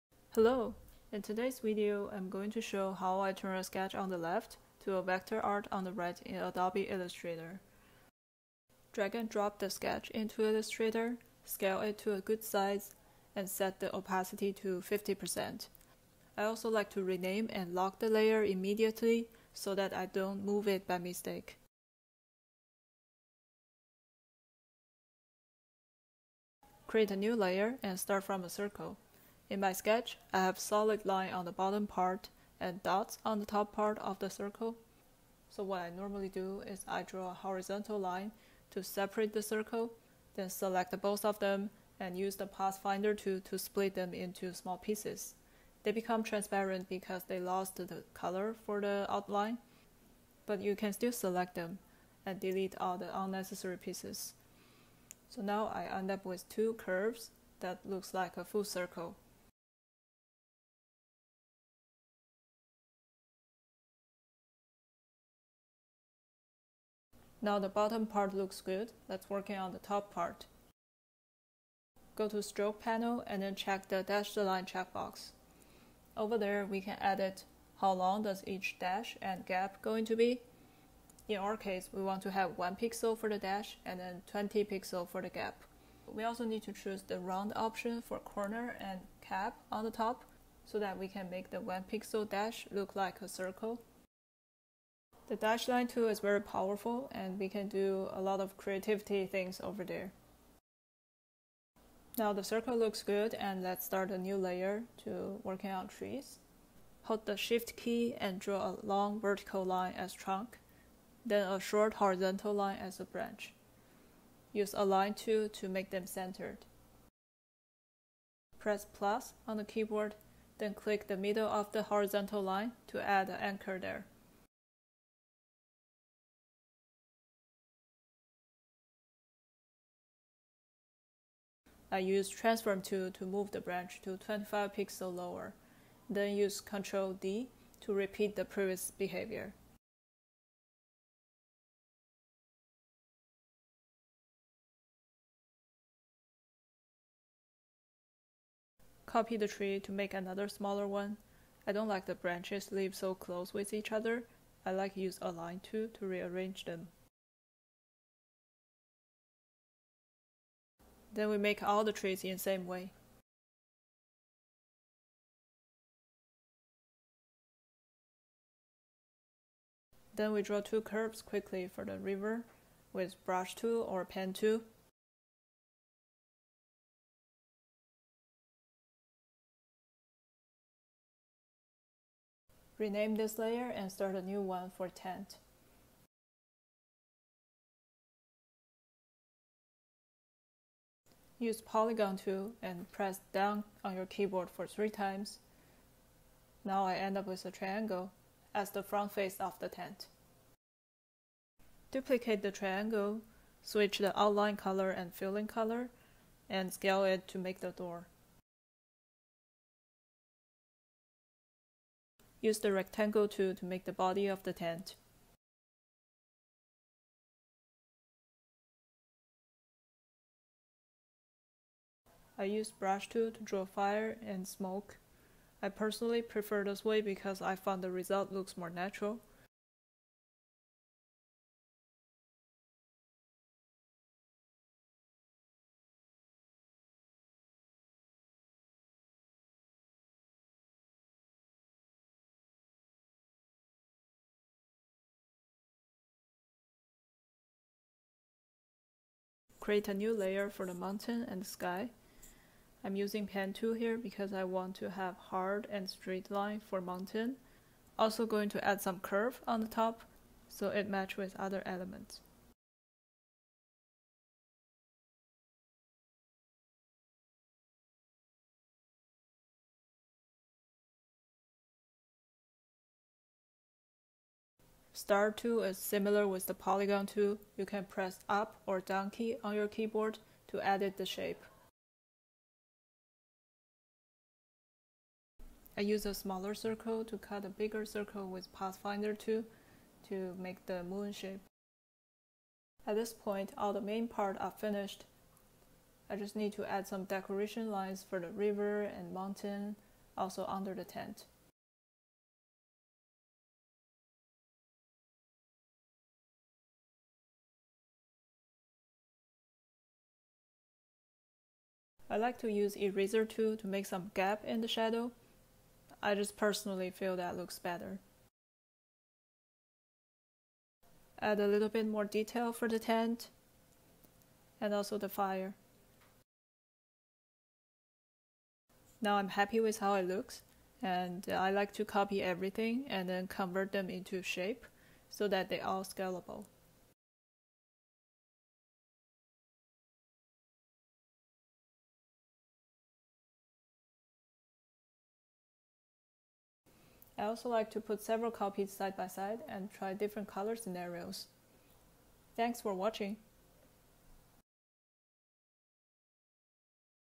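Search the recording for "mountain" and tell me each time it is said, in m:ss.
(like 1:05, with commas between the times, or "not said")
4:10, 4:16, 4:59.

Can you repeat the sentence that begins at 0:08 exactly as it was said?
Drag and drop the sketch into Illustrator, scale it to a good size, and set the opacity to 50%.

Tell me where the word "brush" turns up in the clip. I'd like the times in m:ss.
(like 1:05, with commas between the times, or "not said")
2:53, 3:42.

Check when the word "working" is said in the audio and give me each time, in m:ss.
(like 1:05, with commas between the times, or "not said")
1:09, 1:45.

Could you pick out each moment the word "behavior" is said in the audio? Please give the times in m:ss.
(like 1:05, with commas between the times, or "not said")
2:18.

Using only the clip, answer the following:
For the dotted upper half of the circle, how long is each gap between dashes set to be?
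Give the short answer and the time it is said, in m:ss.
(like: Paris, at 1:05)
20 pixels, at 1:24.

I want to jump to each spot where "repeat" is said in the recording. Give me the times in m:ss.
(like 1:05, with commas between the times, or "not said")
2:17.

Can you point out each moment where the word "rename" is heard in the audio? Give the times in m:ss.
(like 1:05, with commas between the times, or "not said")
0:17, 3:02.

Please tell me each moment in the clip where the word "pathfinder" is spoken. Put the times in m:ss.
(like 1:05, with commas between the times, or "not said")
0:42, 4:48.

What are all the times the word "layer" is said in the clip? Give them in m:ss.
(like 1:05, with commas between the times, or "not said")
0:18, 0:27, 1:44, 3:03, 4:10.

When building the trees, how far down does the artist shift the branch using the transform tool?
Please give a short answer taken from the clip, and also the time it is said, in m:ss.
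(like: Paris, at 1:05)
25 pixels, at 2:14.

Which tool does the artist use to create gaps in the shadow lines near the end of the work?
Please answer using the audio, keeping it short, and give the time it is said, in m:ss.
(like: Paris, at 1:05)
eraser tool, at 5:12.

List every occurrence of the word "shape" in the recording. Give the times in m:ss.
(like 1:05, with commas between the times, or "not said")
4:41, 4:51, 5:34.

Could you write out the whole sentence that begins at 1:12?
Go to stroke panel and then check the dash the line checkbox.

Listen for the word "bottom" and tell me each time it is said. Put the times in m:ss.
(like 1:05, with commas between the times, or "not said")
0:31, 1:07.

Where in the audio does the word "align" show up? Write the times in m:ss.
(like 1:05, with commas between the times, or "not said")
1:54, 2:35.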